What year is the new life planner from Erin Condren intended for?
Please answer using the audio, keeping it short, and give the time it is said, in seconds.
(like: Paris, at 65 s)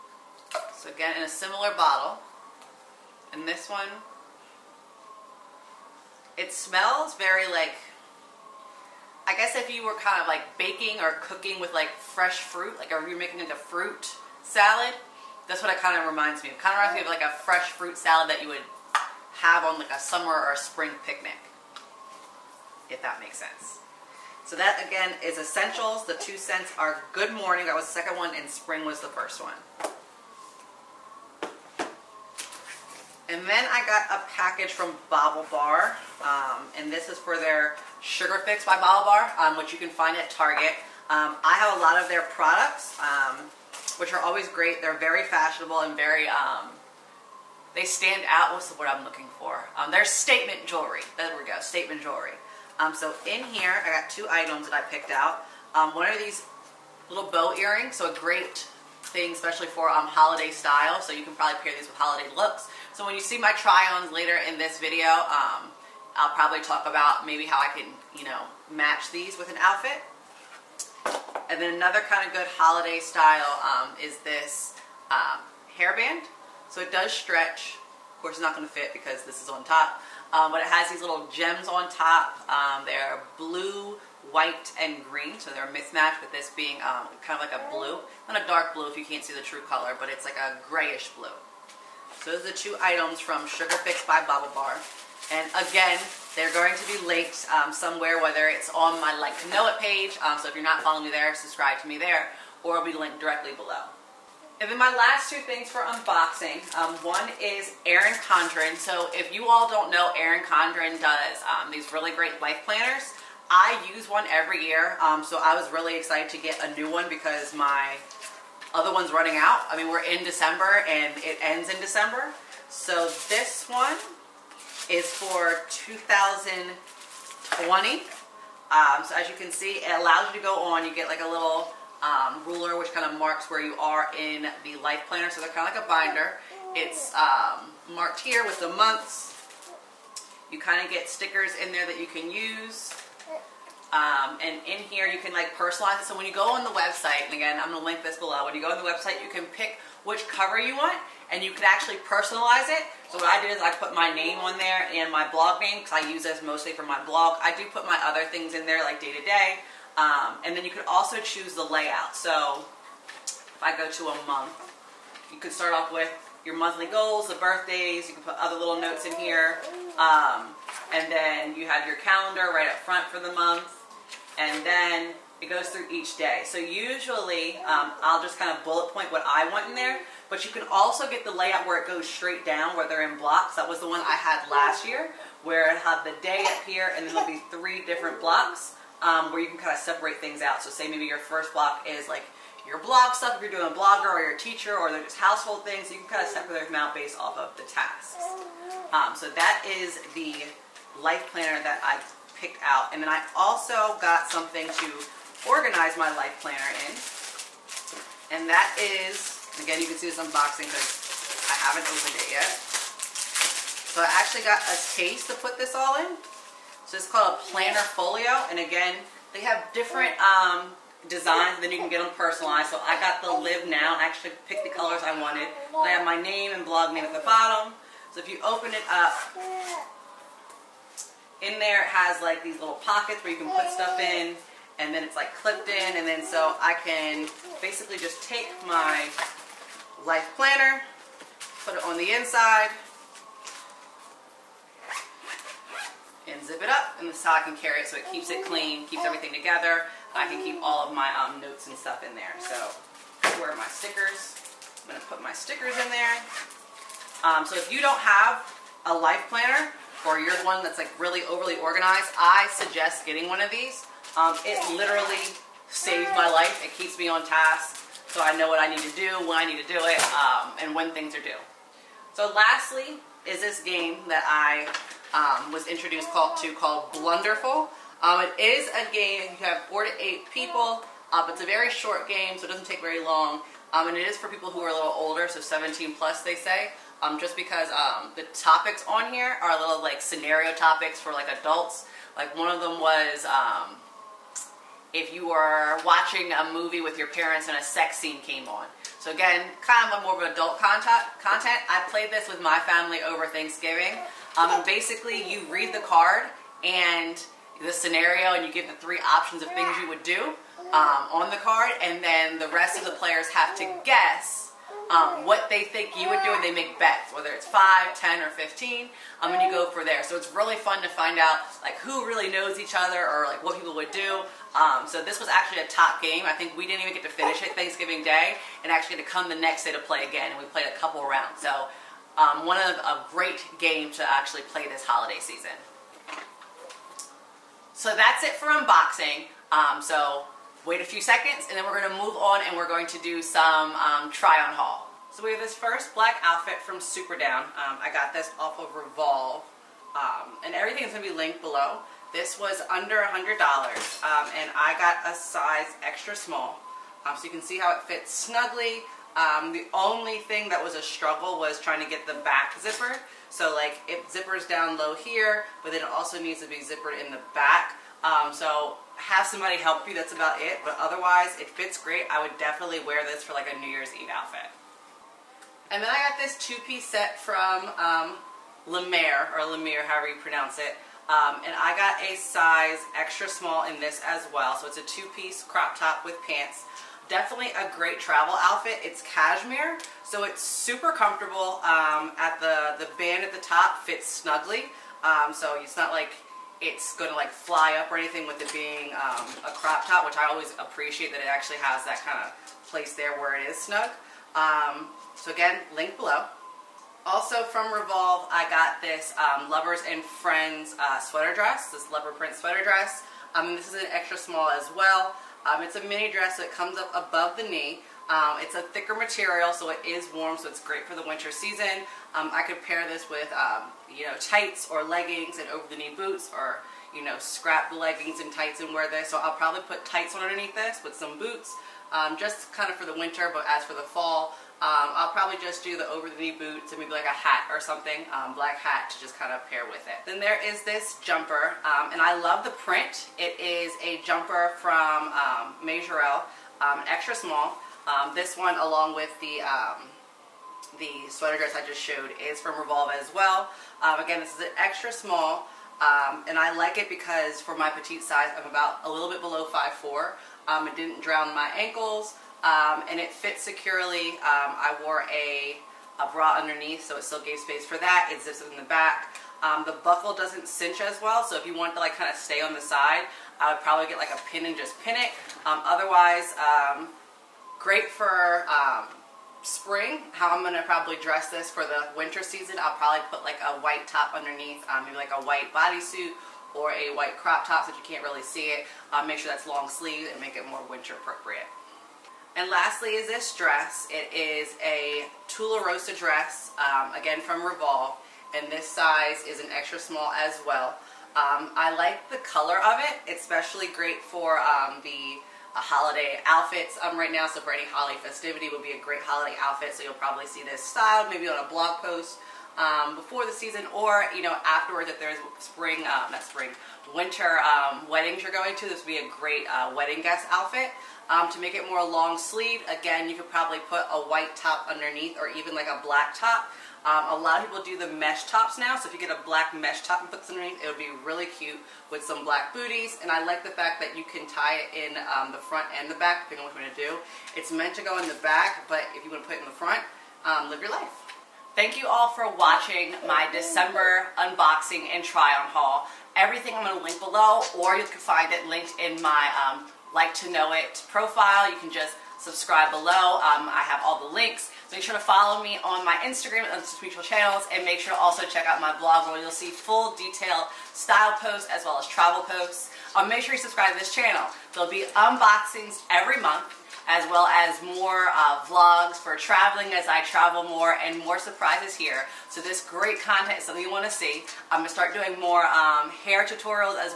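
2020, at 125 s.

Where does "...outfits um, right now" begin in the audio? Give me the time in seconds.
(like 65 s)
506 s.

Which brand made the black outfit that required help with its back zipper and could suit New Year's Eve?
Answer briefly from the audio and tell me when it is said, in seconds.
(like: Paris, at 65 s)
Superdown, at 346 s.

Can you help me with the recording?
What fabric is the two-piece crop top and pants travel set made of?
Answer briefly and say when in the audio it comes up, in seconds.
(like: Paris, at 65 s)
cashmere, at 389 s.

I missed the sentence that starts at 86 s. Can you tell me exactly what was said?
with this being um, kind of like a blue.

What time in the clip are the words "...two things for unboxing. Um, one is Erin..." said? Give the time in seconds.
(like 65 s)
105 s.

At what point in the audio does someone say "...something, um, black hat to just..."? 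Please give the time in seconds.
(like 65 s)
437 s.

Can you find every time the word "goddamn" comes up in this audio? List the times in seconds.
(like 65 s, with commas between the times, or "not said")
not said.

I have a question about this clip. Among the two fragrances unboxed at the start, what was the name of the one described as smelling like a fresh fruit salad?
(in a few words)
Good Morning.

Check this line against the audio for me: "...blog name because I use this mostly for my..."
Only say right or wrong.
right.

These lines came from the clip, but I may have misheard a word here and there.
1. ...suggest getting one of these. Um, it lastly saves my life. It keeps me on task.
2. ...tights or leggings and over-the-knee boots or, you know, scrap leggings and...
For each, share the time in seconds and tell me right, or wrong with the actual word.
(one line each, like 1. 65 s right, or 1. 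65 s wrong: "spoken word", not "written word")
1. 262 s wrong: "literally", not "lastly"
2. 424 s right.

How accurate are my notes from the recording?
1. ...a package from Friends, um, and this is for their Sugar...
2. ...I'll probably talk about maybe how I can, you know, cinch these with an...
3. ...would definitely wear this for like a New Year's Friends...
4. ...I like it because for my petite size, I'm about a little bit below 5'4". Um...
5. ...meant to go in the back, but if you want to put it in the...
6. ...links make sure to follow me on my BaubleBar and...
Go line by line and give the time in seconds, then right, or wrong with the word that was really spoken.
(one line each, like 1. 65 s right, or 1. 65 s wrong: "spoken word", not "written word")
1. 34 s wrong: "BaubleBar", not "Friends"
2. 66 s wrong: "match", not "cinch"
3. 372 s wrong: "Eve", not "Friends"
4. 456 s right
5. 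537 s right
6. 554 s wrong: "Instagram", not "BaubleBar".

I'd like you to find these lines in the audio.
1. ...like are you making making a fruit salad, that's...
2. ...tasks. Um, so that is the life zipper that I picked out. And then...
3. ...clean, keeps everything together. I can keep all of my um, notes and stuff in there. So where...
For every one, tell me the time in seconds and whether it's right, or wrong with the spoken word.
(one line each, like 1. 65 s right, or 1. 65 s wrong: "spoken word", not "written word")
1. 12 s right
2. 197 s wrong: "planner", not "zipper"
3. 248 s right.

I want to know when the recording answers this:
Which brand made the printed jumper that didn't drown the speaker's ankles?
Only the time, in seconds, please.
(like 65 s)
445 s.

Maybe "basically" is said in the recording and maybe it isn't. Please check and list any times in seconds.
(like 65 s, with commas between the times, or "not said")
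237 s, 304 s.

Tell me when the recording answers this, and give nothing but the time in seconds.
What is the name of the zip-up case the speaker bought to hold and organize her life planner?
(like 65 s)
217 s.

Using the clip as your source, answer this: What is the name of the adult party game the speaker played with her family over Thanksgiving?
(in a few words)
Blunderful.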